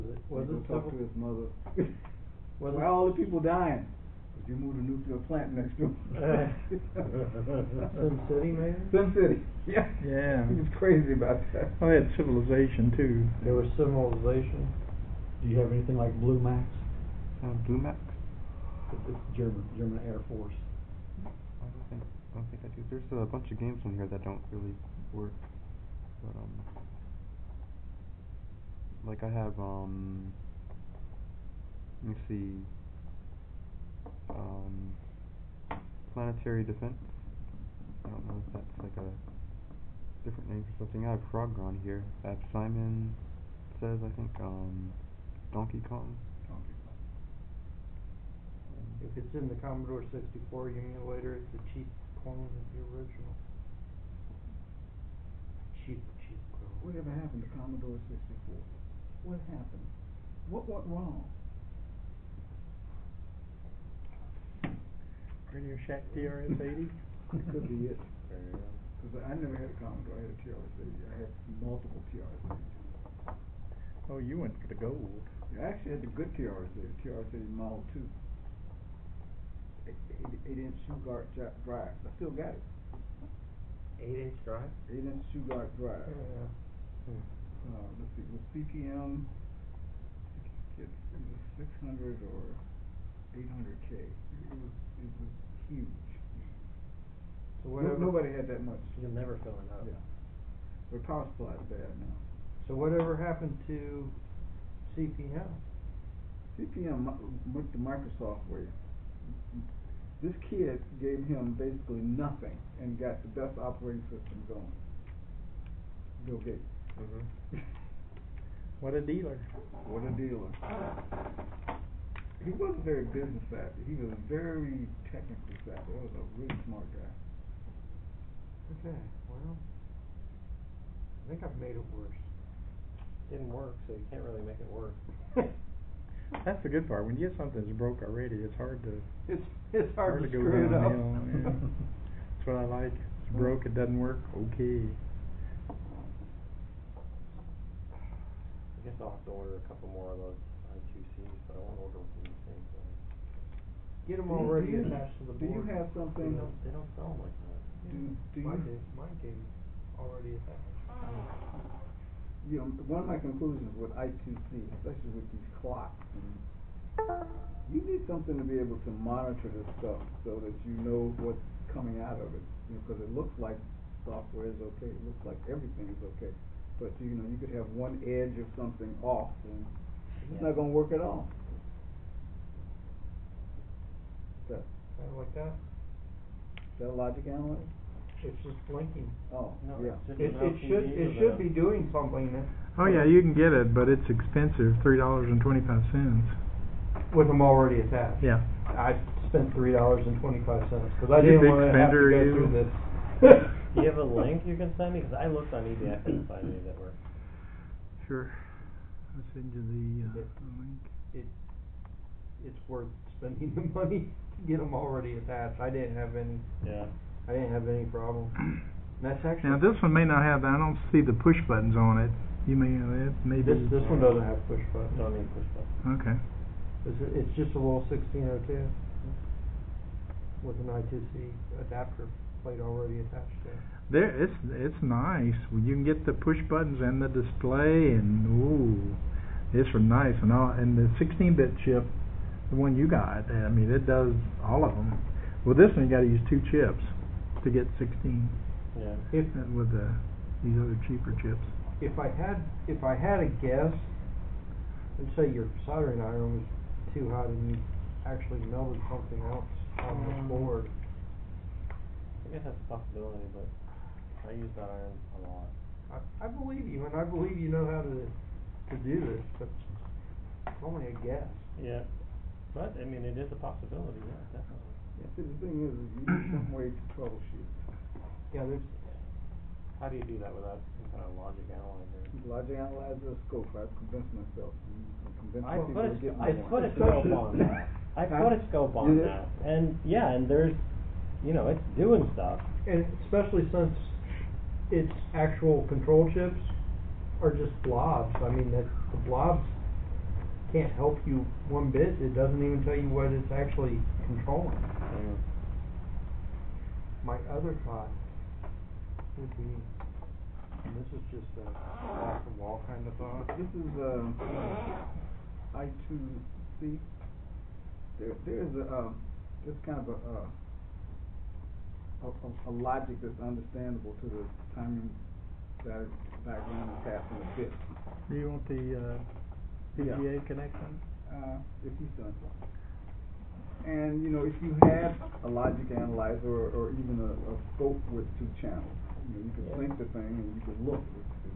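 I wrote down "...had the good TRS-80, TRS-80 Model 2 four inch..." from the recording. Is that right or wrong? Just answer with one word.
wrong.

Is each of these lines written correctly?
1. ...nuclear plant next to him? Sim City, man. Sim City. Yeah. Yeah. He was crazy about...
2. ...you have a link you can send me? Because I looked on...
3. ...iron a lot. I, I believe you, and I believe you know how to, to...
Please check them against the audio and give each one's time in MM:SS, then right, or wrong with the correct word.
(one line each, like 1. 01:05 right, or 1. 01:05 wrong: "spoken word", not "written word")
1. 00:04 right
2. 03:23 right
3. 04:24 right.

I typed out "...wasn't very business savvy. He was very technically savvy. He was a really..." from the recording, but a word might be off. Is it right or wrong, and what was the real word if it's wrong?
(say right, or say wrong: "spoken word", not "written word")
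right.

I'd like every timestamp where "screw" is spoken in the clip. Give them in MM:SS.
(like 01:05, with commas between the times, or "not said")
02:20.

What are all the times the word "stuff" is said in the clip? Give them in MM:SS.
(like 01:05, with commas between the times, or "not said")
02:49, 04:52.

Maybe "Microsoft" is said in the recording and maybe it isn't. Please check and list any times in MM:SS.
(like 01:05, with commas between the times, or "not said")
01:47.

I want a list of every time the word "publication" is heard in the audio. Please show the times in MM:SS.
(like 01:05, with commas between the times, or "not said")
not said.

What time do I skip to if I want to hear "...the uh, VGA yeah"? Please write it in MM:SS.
05:28.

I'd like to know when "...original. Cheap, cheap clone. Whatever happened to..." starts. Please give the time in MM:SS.
00:52.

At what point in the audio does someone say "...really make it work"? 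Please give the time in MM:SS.
02:14.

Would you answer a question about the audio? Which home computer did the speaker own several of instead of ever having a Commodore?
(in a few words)
TRS-80.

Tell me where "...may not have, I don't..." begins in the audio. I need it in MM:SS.
03:39.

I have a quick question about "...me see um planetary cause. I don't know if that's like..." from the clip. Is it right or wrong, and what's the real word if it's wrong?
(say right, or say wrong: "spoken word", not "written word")
wrong: "defense", not "cause".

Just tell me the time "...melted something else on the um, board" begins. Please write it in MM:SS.
04:18.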